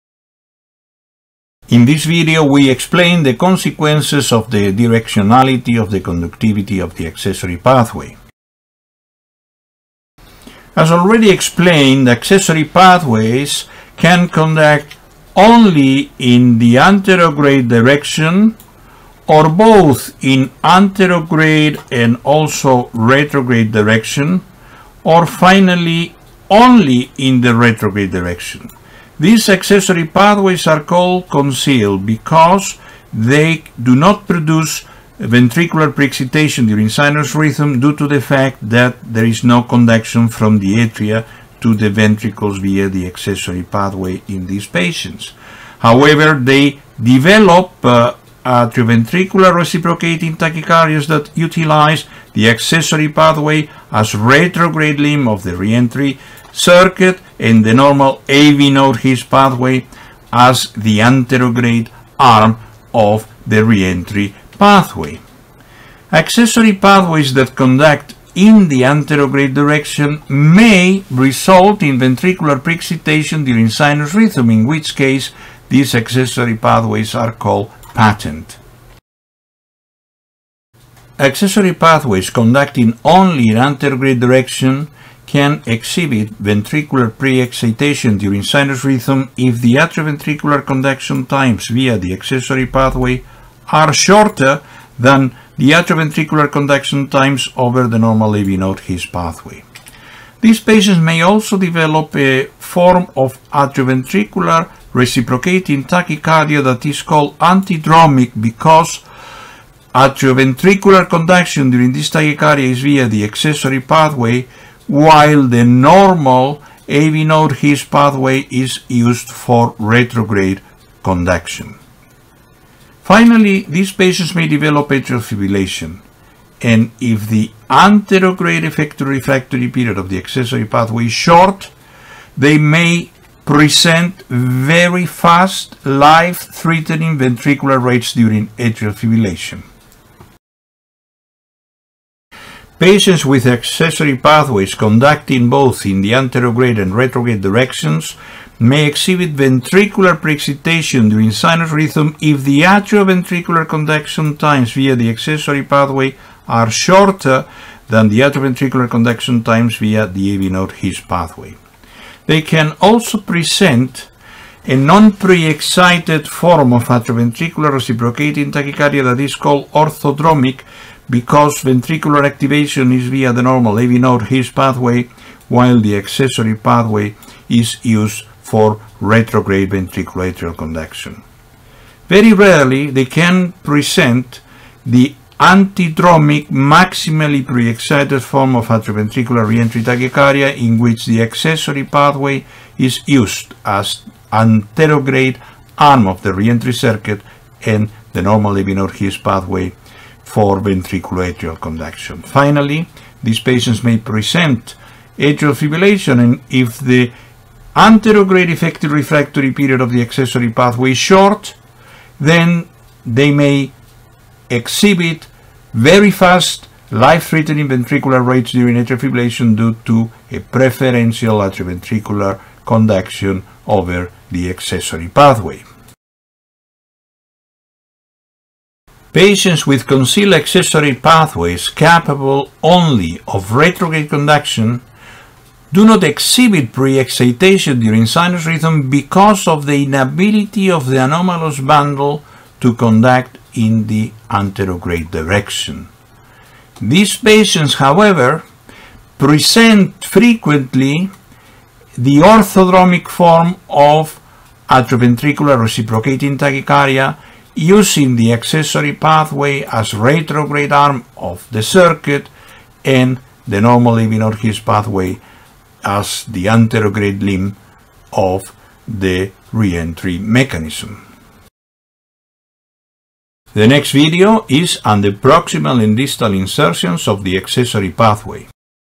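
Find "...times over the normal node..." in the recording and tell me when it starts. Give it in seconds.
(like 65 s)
97 s.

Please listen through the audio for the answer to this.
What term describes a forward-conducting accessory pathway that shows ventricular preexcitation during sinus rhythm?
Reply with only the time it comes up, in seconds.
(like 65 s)
77 s.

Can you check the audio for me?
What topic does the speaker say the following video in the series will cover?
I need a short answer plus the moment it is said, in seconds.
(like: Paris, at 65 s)
proximal and distal insertions, at 275 s.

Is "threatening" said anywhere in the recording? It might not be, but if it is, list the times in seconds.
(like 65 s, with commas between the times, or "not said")
135 s, 216 s.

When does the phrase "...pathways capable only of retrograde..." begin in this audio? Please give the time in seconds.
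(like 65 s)
230 s.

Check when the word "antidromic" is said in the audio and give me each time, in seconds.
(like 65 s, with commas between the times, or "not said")
107 s, 185 s.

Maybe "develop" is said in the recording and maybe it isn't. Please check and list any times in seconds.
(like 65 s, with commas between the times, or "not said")
47 s, 101 s, 124 s.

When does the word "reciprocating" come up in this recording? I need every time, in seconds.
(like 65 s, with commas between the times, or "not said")
49 s, 105 s, 167 s, 255 s.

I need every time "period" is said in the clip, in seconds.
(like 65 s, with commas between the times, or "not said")
129 s, 209 s.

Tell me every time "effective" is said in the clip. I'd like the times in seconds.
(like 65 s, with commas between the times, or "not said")
128 s, 208 s.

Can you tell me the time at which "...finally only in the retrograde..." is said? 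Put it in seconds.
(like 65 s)
25 s.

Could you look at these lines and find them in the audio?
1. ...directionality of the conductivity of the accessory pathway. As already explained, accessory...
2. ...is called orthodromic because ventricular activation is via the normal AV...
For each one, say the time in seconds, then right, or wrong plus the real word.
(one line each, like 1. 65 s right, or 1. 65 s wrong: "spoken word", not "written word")
1. 4 s right
2. 169 s right.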